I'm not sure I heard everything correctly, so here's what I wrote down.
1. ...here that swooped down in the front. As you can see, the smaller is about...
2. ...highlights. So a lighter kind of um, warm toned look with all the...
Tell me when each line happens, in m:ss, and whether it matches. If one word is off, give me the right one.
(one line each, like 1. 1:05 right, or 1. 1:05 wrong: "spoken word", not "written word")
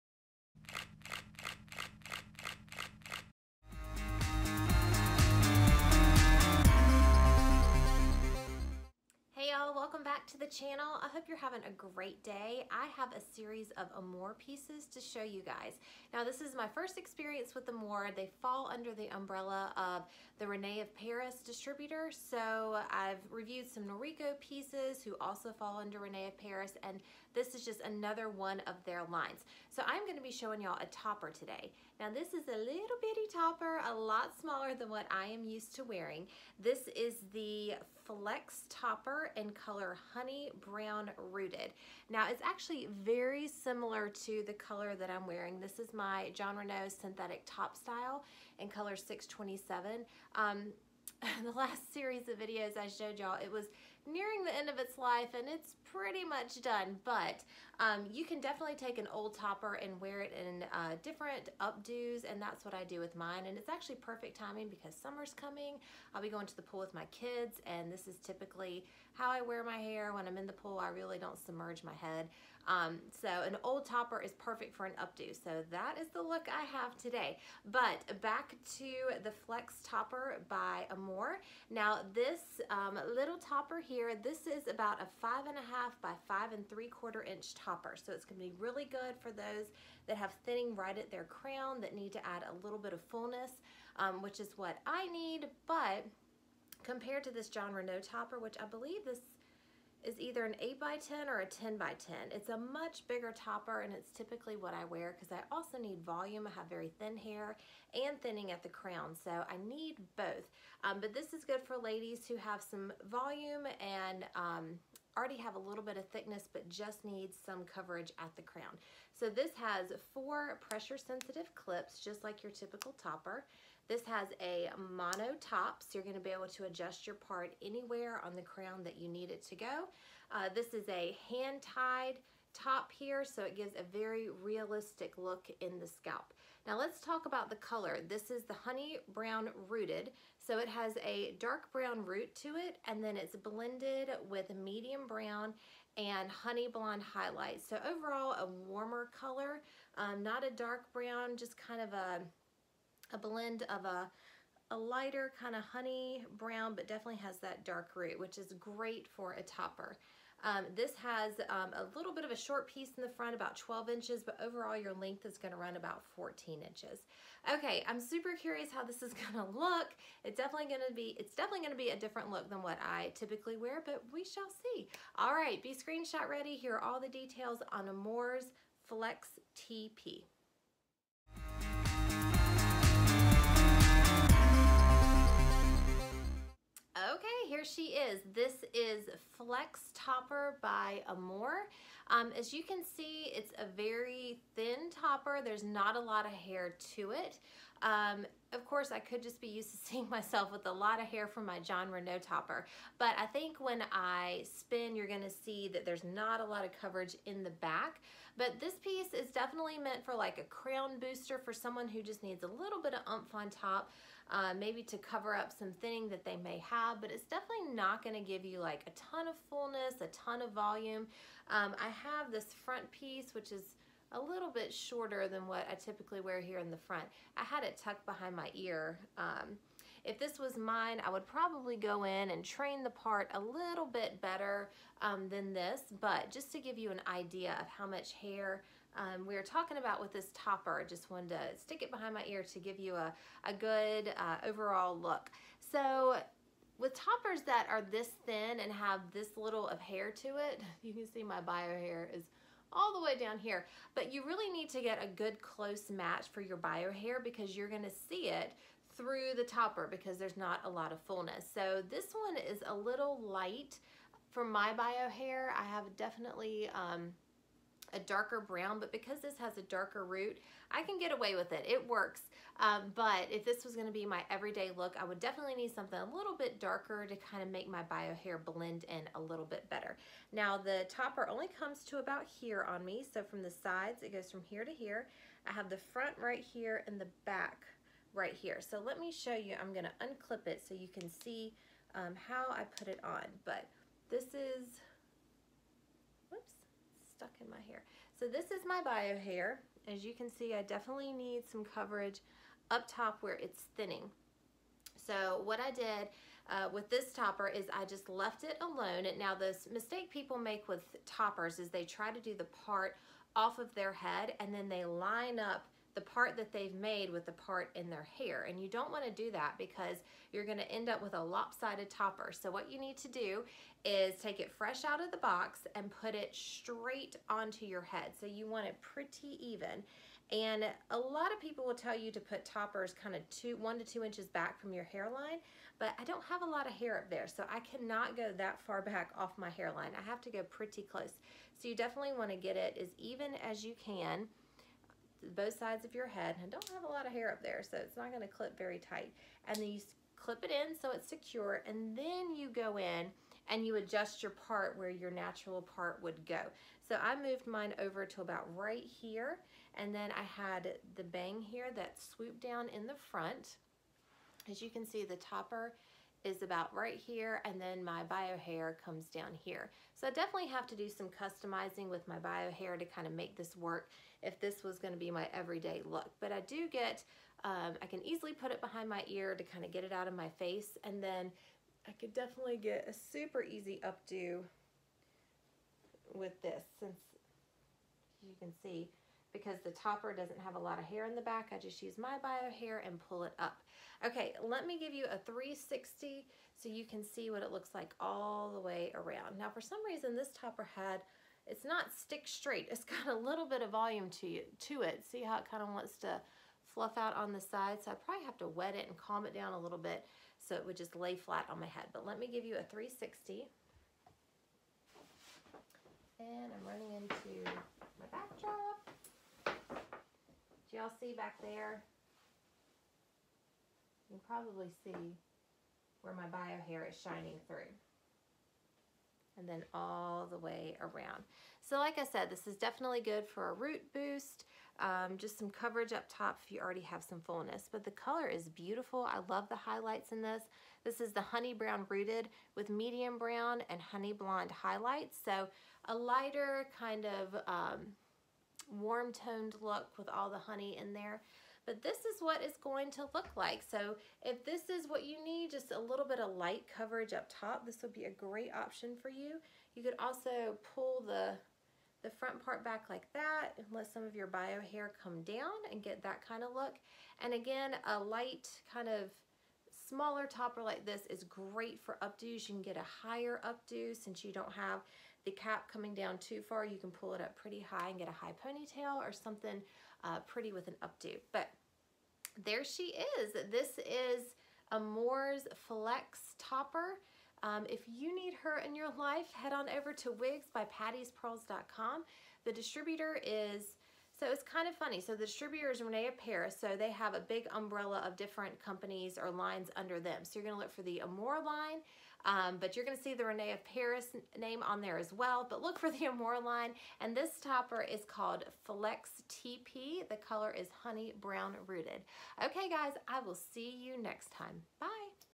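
1. 6:01 wrong: "topper", not "smaller"
2. 7:24 right.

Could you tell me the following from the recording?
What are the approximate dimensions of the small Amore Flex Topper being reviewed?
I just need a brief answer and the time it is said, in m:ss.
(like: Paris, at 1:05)
5.5 by 5.75 inches, at 1:25.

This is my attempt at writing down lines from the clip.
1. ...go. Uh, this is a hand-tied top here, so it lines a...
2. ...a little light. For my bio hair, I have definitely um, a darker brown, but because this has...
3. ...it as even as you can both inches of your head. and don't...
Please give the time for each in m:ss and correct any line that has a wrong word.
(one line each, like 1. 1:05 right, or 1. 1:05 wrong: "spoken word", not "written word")
1. 2:09 wrong: "gives", not "lines"
2. 4:22 right
3. 5:42 wrong: "sides", not "inches".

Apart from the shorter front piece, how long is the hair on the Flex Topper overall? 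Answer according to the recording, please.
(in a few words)
14 inches.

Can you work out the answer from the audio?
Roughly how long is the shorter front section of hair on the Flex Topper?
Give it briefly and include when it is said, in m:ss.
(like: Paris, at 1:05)
12 inches, at 2:43.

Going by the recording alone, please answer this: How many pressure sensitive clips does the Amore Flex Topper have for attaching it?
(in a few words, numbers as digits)
4.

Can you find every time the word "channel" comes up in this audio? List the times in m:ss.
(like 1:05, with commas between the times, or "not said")
0:10.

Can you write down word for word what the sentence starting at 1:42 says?
It's a much bigger topper and it's typically what I wear because I also need volume.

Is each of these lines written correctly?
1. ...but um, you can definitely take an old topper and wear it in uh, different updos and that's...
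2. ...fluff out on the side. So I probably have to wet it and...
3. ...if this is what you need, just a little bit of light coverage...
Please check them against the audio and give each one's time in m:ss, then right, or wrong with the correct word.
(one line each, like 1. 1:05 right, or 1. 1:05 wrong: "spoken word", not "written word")
1. 0:57 right
2. 6:46 right
3. 7:34 right.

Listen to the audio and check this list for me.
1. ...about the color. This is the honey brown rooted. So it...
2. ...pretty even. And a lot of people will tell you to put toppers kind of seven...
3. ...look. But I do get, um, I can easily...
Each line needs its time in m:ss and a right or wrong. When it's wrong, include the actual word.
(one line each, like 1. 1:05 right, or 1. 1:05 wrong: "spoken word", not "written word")
1. 2:17 right
2. 5:28 wrong: "two", not "seven"
3. 6:15 right.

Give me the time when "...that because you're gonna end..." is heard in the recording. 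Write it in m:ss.
5:19.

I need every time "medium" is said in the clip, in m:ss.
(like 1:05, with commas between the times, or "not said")
2:24, 7:22.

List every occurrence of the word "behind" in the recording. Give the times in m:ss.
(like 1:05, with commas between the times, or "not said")
3:48, 4:01, 6:18.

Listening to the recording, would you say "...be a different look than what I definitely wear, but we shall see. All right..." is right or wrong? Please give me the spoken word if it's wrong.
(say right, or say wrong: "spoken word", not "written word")
wrong: "typically", not "definitely".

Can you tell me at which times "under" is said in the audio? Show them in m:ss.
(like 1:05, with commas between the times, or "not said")
0:18, 0:25, 8:19.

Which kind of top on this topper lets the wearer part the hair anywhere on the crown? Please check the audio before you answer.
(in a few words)
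Mono top.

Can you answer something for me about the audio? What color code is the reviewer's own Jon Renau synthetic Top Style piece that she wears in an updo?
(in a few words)
627.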